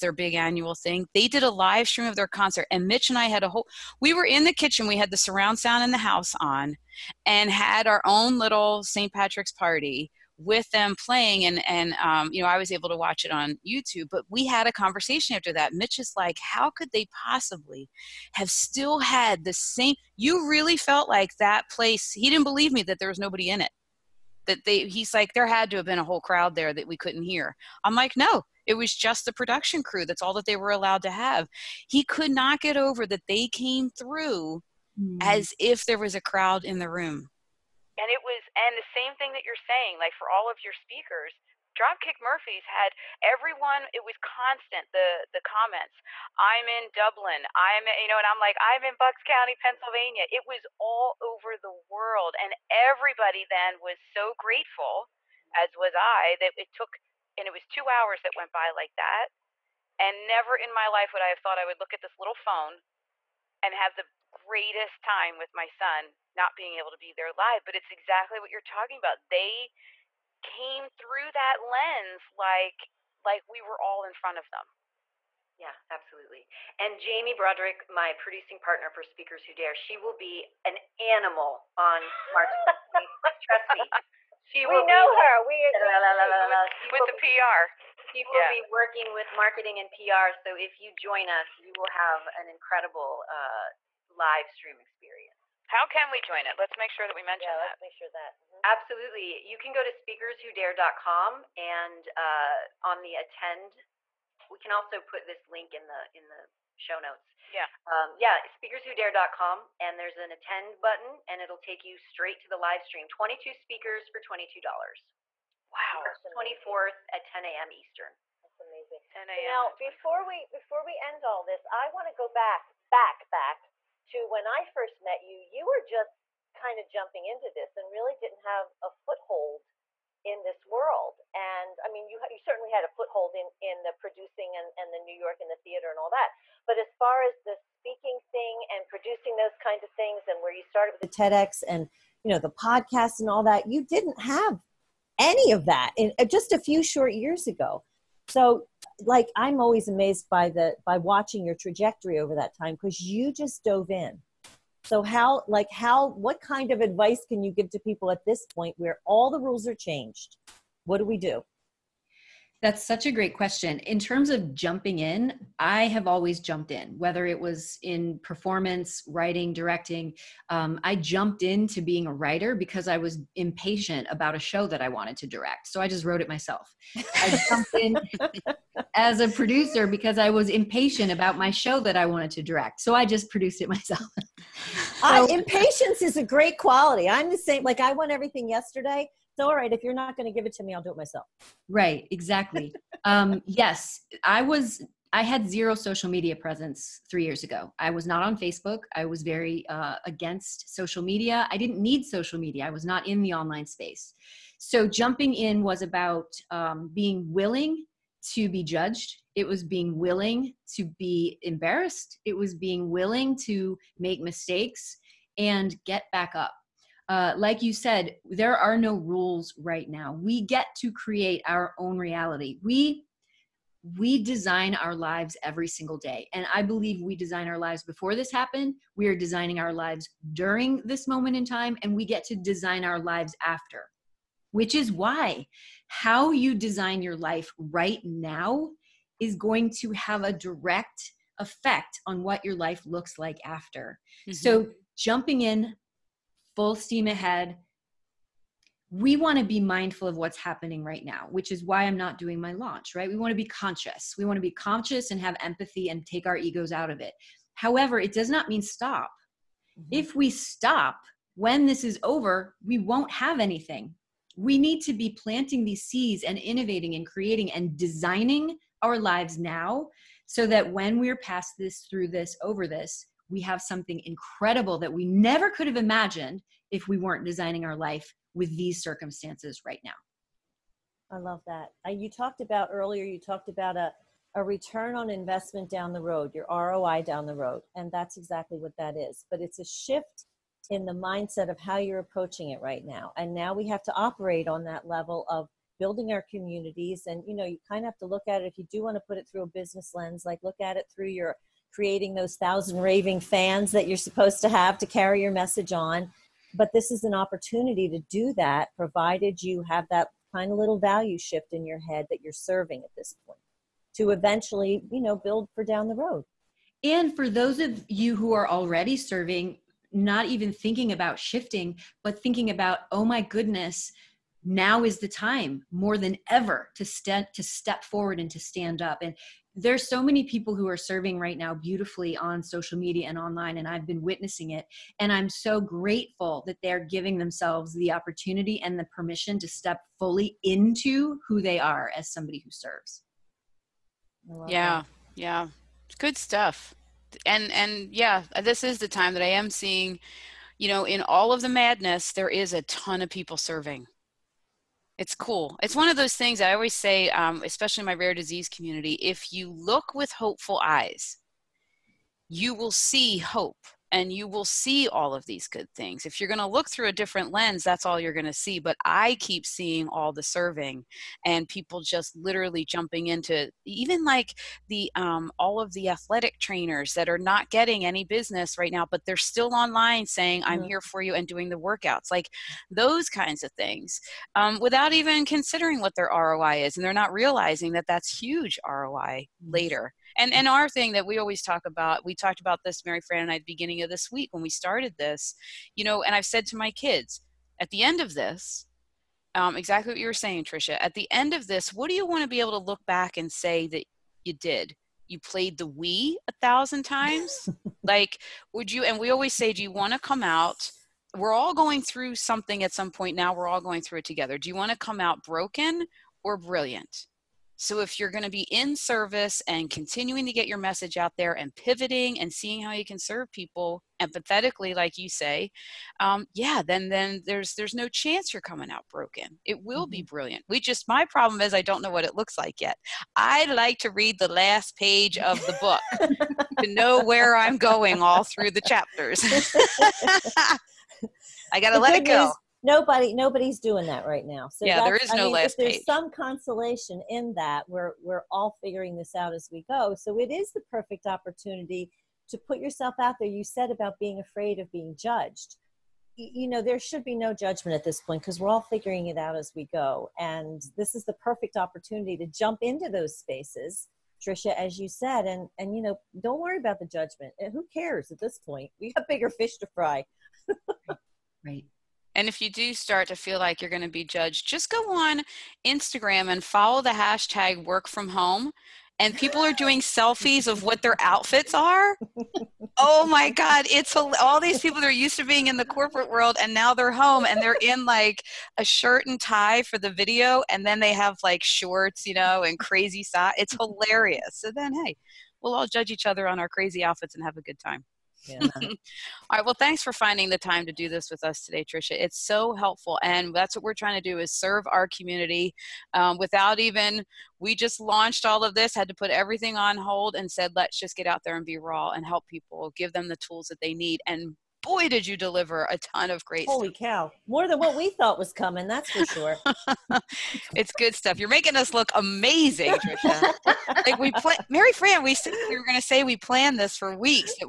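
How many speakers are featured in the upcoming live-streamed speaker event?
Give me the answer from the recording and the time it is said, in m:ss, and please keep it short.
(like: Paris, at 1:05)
22, at 1:53.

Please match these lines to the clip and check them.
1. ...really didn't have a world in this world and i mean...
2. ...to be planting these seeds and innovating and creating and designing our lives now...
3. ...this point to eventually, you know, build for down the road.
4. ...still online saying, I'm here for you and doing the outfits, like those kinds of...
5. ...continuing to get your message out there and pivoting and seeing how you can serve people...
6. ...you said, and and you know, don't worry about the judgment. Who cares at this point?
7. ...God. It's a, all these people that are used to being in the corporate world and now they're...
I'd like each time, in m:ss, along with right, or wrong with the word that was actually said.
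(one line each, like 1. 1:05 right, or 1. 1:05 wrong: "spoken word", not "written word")
1. 2:07 wrong: "foothold", not "world"
2. 4:24 right
3. 5:12 right
4. 6:19 wrong: "workouts", not "outfits"
5. 6:59 right
6. 7:44 right
7. 8:03 right.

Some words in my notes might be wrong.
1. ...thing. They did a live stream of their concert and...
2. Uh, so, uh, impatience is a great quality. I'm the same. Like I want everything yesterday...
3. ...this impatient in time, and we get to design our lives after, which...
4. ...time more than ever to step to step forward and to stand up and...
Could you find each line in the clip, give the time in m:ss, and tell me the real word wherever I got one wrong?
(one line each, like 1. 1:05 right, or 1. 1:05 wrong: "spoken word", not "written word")
1. 0:00 right
2. 3:04 right
3. 3:50 wrong: "moment", not "impatient"
4. 5:25 right.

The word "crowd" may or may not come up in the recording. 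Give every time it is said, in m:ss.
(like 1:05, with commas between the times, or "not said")
0:26, 0:36.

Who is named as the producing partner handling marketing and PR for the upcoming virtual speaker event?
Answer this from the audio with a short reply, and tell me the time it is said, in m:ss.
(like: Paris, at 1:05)
Jamie Broderick, at 1:16.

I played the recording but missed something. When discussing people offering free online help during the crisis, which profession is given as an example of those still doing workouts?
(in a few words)
Athletic trainers.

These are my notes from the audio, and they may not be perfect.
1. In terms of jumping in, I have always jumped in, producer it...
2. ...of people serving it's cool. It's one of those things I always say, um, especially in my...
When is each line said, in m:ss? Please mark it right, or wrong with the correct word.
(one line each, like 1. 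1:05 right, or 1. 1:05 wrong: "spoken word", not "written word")
1. 2:43 wrong: "whether", not "producer"
2. 5:53 right.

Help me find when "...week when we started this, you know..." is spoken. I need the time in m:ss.
6:34.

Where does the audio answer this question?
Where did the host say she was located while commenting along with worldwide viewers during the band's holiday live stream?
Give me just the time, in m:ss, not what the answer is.
0:48.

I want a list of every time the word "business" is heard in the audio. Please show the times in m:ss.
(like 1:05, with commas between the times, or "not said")
4:59, 6:18.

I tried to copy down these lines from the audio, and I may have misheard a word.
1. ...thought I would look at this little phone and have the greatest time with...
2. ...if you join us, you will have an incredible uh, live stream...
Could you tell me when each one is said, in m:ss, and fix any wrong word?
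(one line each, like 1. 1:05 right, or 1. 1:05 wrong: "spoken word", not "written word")
1. 1:01 right
2. 1:30 right.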